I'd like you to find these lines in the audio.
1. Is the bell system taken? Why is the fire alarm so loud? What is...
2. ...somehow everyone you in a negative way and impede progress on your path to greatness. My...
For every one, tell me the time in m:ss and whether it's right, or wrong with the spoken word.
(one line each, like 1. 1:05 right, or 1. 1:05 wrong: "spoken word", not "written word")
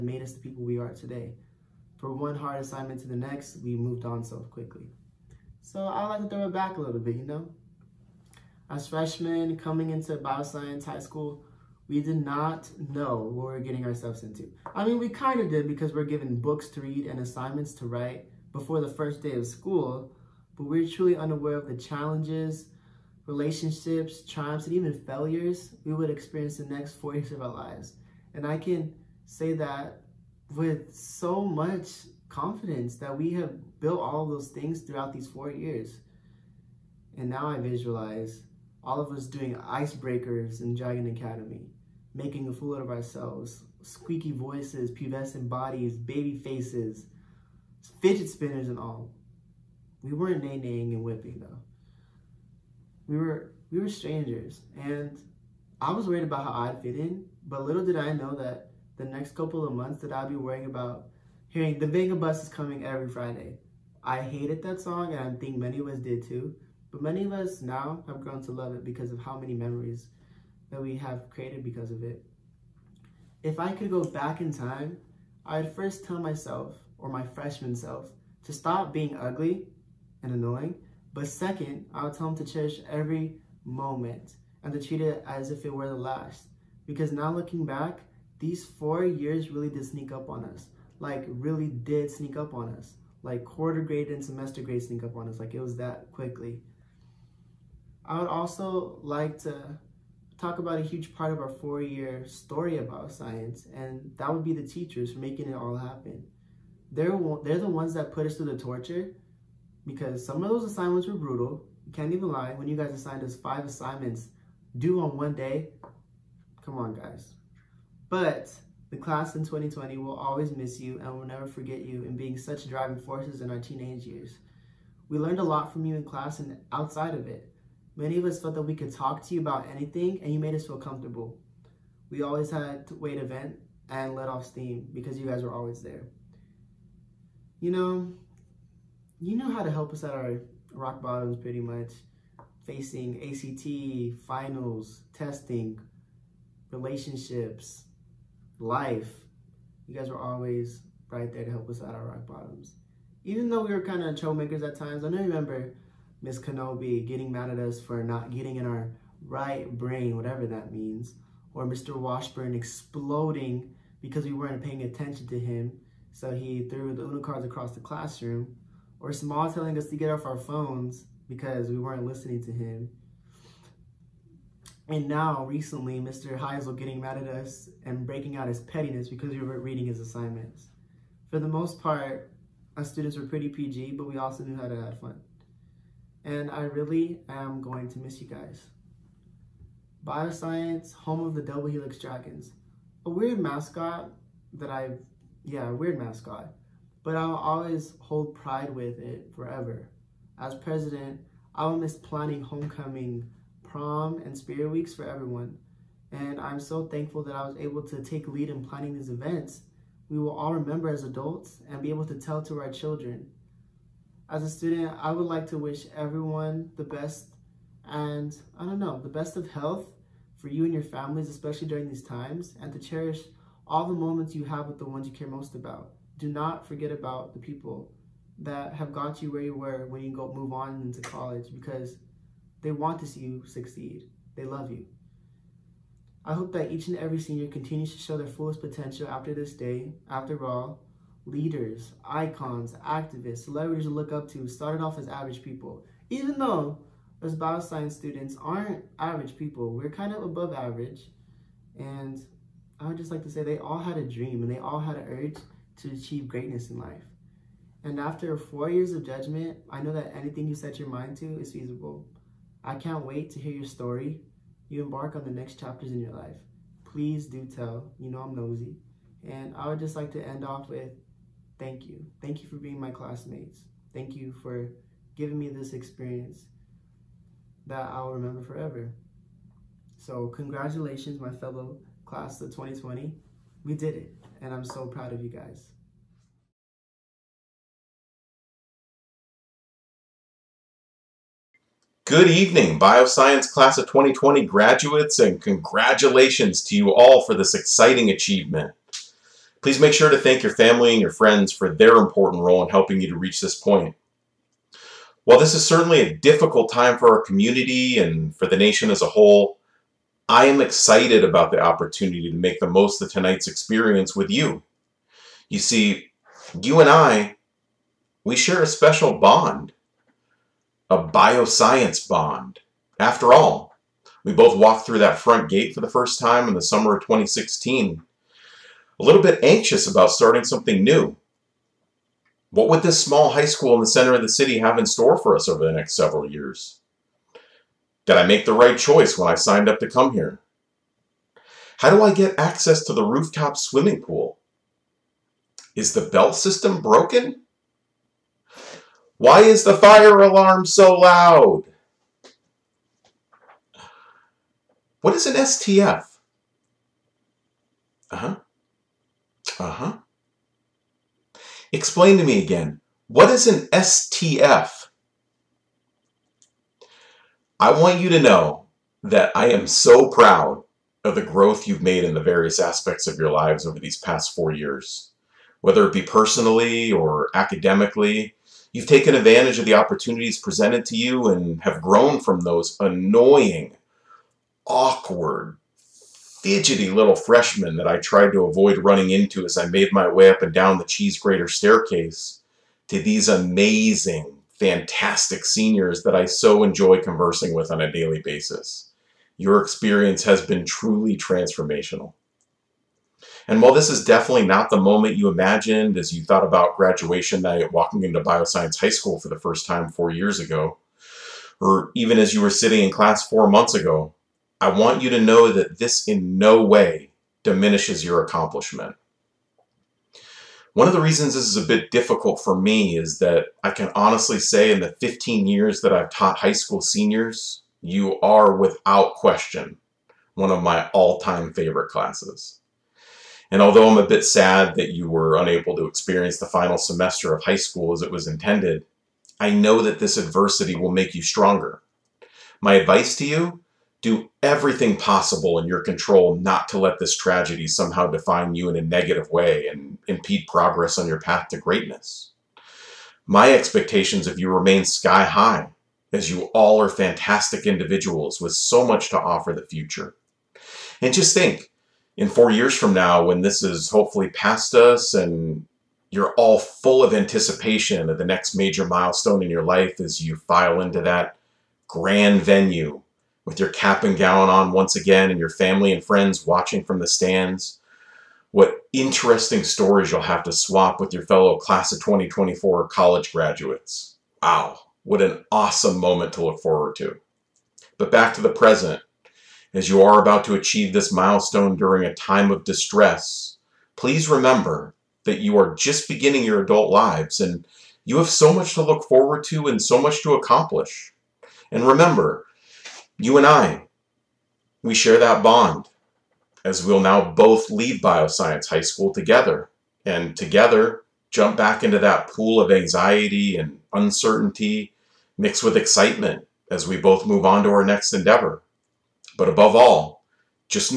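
1. 5:45 wrong: "broken", not "taken"
2. 7:27 wrong: "define", not "everyone".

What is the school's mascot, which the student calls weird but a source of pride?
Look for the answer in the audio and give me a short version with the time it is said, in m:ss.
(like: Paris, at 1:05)
double helix dragons, at 3:11.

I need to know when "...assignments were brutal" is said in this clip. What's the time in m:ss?
1:50.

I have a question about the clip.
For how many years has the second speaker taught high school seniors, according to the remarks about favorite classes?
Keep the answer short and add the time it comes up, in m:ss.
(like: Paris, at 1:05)
15, at 7:05.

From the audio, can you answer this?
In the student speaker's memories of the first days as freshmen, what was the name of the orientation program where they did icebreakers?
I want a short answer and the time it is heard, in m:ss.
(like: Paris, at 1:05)
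Dragon Academy, at 0:40.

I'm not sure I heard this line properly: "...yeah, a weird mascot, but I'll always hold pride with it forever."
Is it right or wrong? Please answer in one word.
right.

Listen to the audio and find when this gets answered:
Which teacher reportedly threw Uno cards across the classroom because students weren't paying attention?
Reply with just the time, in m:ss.
2:41.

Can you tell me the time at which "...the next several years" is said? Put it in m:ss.
5:35.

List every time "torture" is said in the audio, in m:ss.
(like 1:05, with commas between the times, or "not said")
1:48.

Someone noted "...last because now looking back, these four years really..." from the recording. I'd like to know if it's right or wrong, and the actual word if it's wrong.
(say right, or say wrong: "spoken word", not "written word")
right.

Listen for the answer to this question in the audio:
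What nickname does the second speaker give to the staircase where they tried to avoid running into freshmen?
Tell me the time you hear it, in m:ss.
6:30.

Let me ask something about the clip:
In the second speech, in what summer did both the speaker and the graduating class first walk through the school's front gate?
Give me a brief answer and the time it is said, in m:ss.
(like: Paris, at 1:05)
2016, at 5:27.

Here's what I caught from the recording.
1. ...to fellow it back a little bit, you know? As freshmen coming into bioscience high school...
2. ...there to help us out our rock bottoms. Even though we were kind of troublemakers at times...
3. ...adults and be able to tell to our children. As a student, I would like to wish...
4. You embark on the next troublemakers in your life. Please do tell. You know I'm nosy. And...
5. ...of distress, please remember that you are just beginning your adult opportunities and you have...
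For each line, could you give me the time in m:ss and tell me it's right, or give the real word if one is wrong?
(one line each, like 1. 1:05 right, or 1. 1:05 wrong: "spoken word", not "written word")
1. 0:06 wrong: "throw", not "fellow"
2. 2:31 right
3. 3:31 right
4. 4:24 wrong: "chapters", not "troublemakers"
5. 8:12 wrong: "lives", not "opportunities".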